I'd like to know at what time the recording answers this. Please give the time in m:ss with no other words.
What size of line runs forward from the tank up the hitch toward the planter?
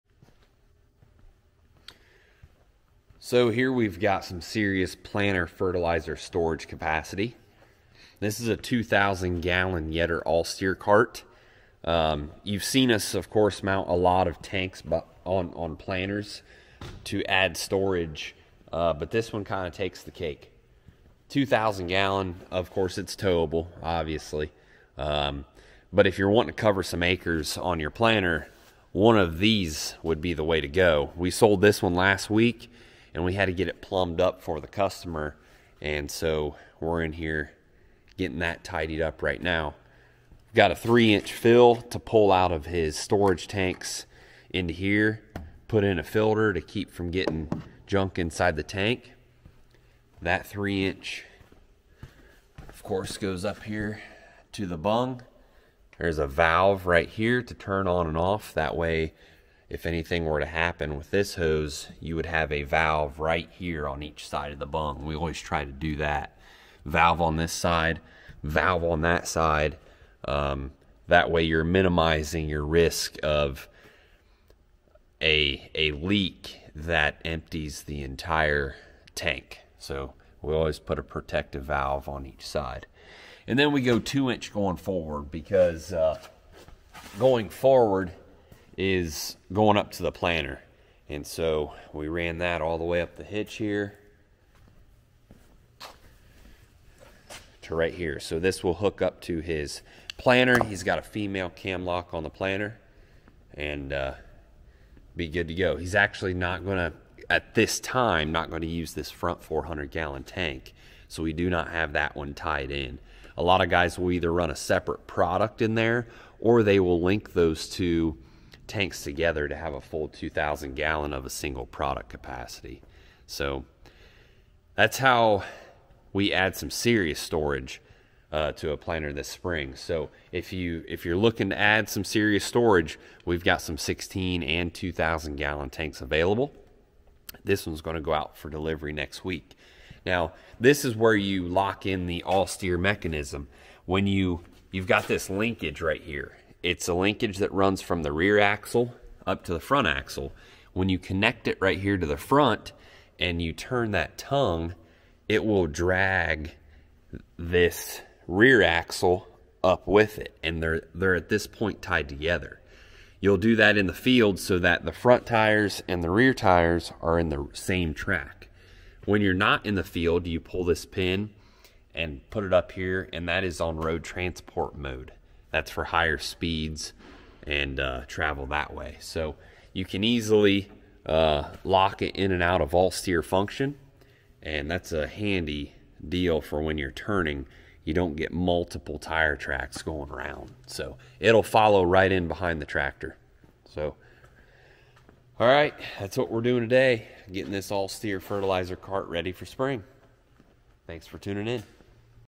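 1:23.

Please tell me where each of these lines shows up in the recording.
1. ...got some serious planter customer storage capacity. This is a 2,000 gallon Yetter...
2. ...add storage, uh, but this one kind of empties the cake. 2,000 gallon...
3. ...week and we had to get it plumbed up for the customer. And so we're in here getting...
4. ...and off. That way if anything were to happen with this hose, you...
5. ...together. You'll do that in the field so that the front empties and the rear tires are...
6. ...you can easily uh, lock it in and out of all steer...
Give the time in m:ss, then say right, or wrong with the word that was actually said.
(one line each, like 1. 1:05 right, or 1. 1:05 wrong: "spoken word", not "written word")
1. 0:03 wrong: "fertilizer", not "customer"
2. 0:17 wrong: "takes", not "empties"
3. 0:32 right
4. 0:58 right
5. 2:42 wrong: "tires", not "empties"
6. 2:59 right.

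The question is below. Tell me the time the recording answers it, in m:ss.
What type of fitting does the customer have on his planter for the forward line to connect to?
1:41.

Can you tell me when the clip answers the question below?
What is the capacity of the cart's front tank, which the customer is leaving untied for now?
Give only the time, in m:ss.
1:49.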